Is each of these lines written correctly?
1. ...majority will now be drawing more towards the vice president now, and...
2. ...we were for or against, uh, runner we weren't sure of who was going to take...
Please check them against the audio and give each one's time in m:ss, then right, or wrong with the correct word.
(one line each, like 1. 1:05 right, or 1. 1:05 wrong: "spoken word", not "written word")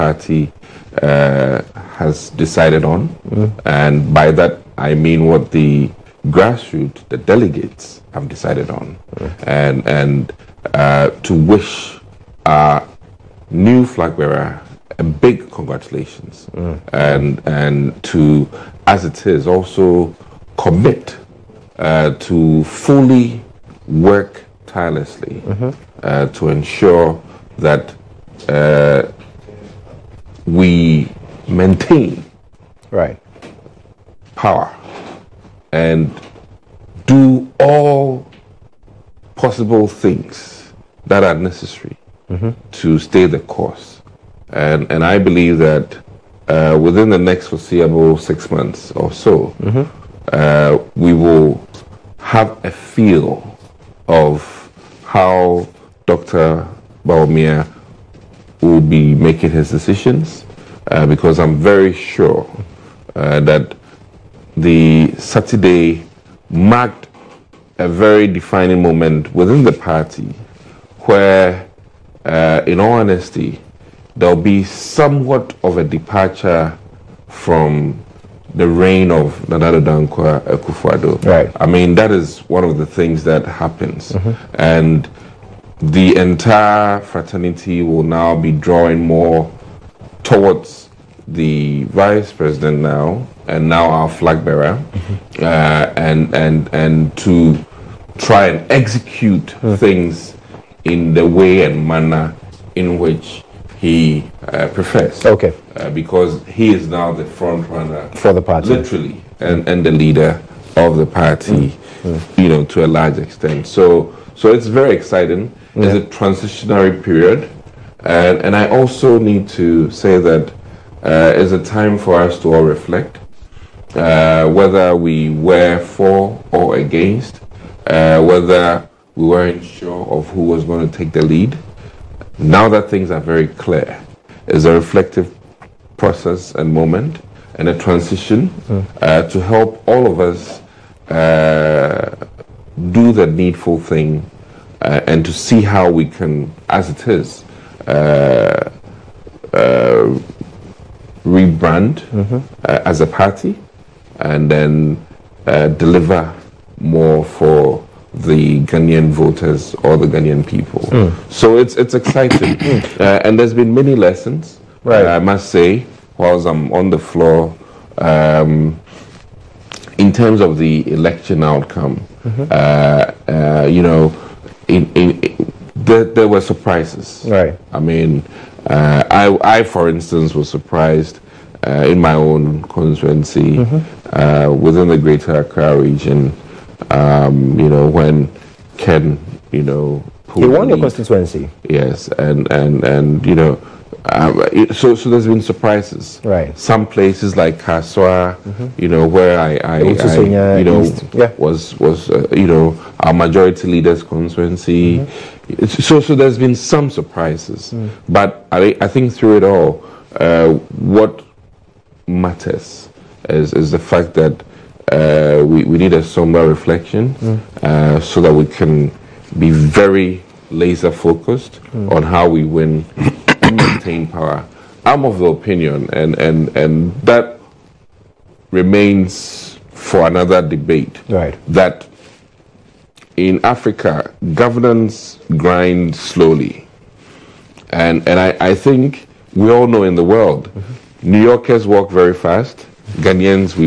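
1. 1:27 wrong: "fraternity", not "majority"
2. 2:04 wrong: "whether", not "runner".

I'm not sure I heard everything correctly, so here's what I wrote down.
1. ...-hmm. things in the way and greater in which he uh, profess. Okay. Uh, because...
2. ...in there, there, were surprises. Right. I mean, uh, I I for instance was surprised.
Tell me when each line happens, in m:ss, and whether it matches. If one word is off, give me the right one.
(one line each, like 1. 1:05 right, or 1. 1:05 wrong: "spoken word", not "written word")
1. 1:39 wrong: "manner", not "greater"
2. 2:55 right.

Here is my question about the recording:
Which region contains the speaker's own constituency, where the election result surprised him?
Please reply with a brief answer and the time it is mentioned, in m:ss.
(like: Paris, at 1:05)
Greater Accra, at 3:04.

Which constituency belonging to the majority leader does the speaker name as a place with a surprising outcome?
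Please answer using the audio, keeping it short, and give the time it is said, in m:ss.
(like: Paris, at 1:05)
Kaswa, at 3:17.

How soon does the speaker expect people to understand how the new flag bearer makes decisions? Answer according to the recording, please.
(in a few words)
6 months.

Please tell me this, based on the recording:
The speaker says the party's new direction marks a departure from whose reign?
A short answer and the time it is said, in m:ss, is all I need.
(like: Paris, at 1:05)
Nana Dankwa Akufo, at 1:19.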